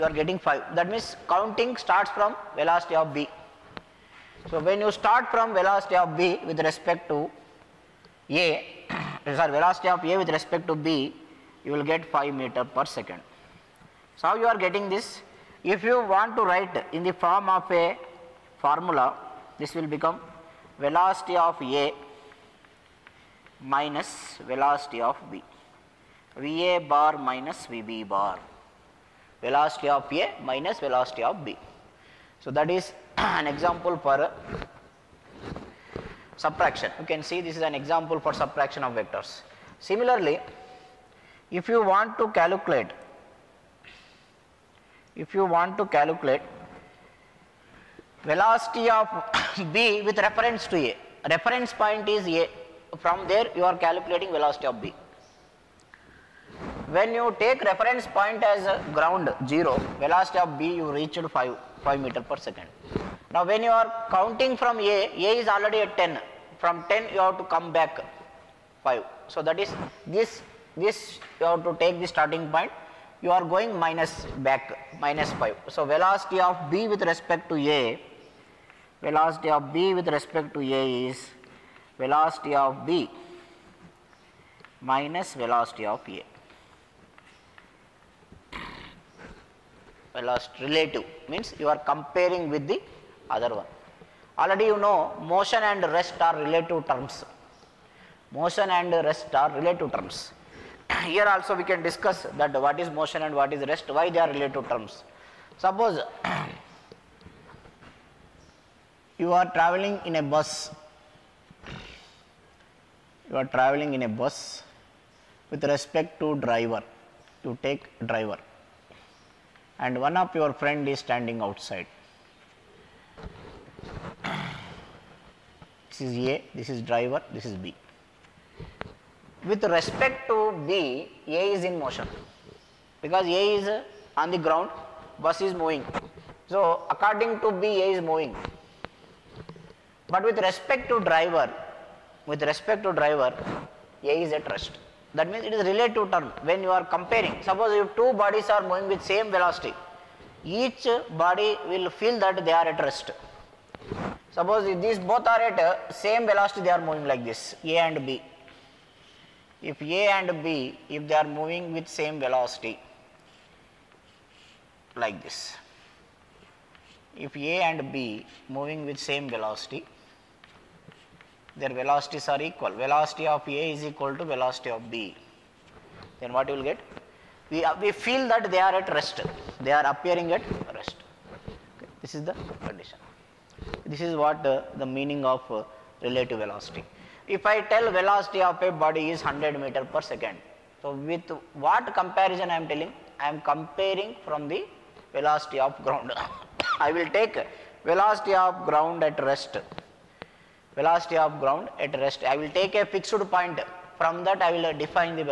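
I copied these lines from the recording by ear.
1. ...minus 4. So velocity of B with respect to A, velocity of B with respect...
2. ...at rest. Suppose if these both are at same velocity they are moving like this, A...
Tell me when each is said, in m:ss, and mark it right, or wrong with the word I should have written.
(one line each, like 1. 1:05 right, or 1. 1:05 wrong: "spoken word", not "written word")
1. 1:14 wrong: "5", not "4"
2. 2:32 right.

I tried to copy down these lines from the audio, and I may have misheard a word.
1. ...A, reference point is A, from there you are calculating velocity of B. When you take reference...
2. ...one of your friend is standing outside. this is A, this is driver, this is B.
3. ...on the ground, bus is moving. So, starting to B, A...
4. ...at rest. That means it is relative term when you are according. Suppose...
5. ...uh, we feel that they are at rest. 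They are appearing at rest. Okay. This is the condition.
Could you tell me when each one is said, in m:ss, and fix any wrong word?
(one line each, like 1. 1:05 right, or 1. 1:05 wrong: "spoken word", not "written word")
1. 0:50 right
2. 2:00 right
3. 2:14 wrong: "according", not "starting"
4. 2:24 wrong: "comparing", not "according"
5. 2:57 right.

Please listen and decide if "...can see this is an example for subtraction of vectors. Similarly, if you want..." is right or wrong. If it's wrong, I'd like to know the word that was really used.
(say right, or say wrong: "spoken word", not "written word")
right.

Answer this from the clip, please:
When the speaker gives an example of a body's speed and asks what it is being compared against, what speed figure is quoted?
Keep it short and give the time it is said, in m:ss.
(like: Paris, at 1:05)
100 meters per second, at 3:09.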